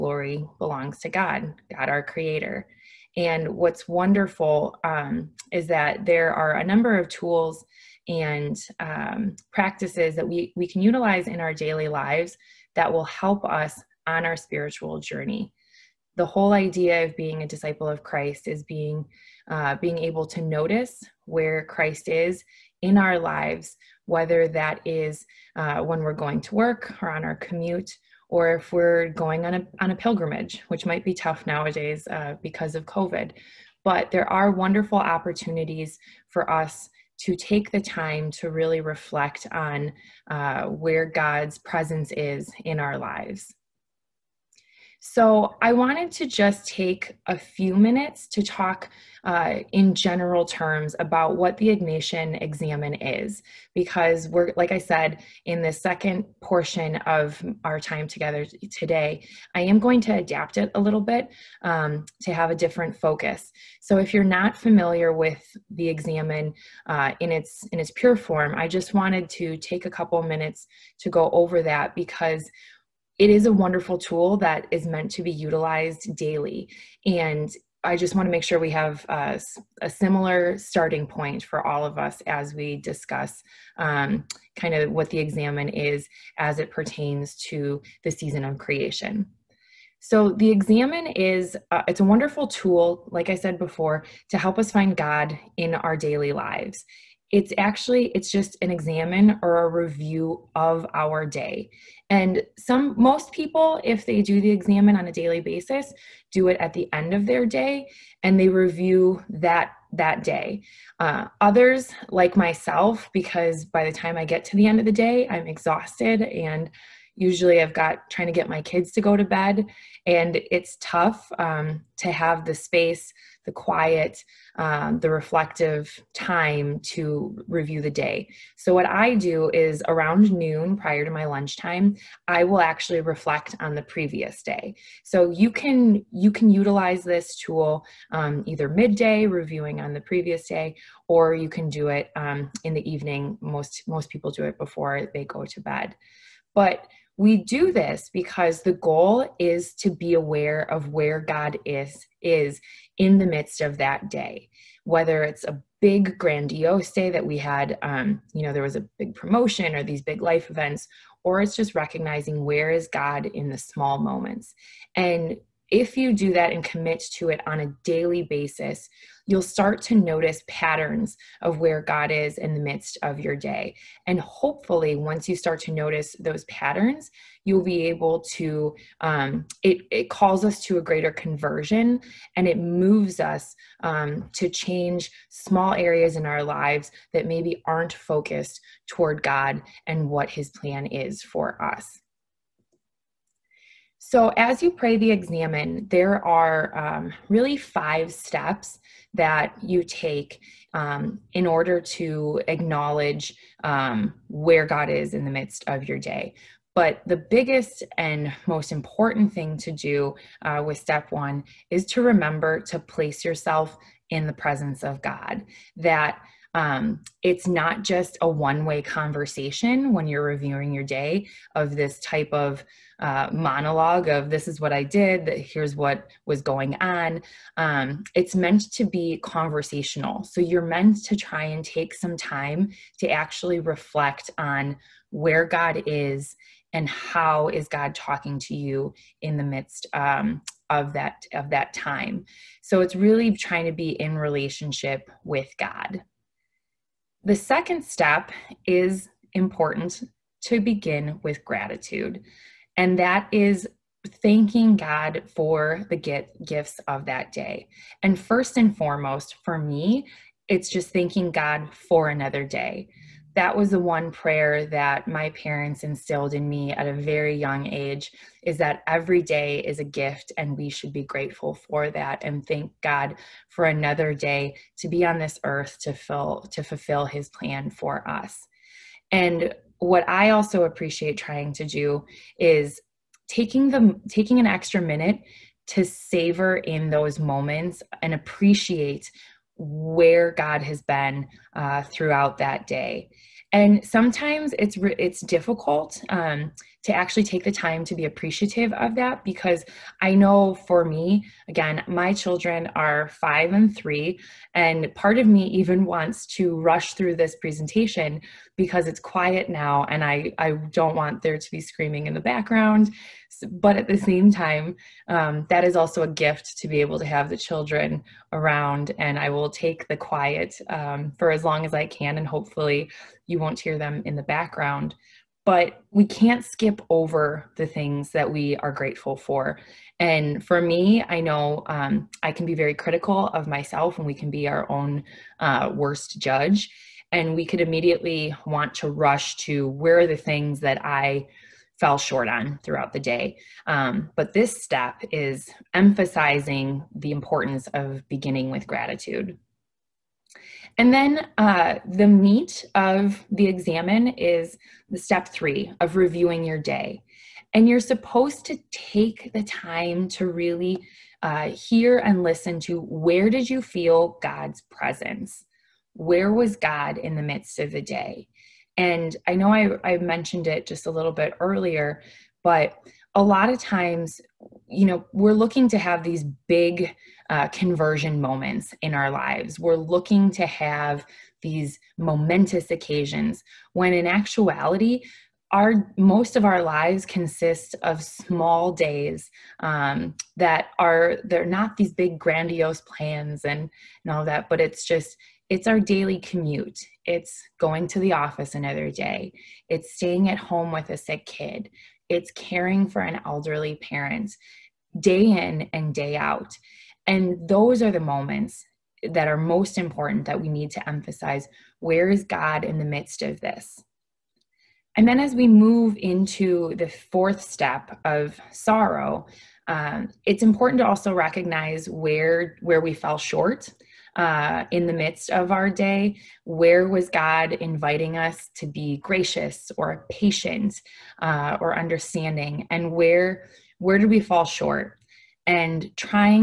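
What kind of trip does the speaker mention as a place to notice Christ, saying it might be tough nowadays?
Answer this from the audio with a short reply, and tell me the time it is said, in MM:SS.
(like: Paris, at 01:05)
A pilgrimage, at 00:29.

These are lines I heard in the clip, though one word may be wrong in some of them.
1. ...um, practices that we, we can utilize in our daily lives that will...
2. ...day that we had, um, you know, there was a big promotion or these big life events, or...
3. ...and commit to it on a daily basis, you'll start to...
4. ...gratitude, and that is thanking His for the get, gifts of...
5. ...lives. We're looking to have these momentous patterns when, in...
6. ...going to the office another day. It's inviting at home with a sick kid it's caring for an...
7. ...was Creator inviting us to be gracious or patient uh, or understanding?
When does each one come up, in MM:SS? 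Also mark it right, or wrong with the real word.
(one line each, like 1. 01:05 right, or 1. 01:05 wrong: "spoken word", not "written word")
1. 00:08 right
2. 02:36 right
3. 02:46 right
4. 04:11 wrong: "God", not "His"
5. 06:19 wrong: "occasions", not "patterns"
6. 06:37 wrong: "staying", not "inviting"
7. 07:06 wrong: "God", not "Creator".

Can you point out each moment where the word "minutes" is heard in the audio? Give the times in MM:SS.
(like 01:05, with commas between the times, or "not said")
00:47, 01:10, 04:44.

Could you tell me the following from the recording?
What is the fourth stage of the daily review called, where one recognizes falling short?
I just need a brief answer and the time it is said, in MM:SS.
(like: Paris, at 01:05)
Sorrow, at 06:58.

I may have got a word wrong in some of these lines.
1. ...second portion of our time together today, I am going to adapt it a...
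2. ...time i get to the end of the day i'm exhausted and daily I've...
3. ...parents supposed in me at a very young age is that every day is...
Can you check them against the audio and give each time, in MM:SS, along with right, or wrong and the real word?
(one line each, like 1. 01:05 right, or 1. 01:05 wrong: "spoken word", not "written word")
1. 00:55 right
2. 01:53 wrong: "usually", not "daily"
3. 04:25 wrong: "instilled", not "supposed".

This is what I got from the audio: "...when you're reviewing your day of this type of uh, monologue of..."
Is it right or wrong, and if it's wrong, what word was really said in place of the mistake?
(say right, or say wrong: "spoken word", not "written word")
right.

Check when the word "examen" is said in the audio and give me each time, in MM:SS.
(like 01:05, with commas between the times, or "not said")
00:52, 01:05, 01:25, 01:30, 01:38, 01:44, 03:15, 05:53.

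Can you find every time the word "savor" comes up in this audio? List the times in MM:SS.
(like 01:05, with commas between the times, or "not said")
04:45.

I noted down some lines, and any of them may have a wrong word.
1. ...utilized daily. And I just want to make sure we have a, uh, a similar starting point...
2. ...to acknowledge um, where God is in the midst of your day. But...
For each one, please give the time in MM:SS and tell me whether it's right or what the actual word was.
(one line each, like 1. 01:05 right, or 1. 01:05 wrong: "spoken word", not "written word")
1. 01:15 right
2. 03:21 right.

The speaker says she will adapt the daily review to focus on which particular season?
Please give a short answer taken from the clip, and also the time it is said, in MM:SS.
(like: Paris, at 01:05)
The season of creation, at 01:28.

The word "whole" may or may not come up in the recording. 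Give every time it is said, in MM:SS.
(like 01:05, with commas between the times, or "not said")
00:16.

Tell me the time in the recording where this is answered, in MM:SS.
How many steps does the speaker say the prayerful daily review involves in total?
03:17.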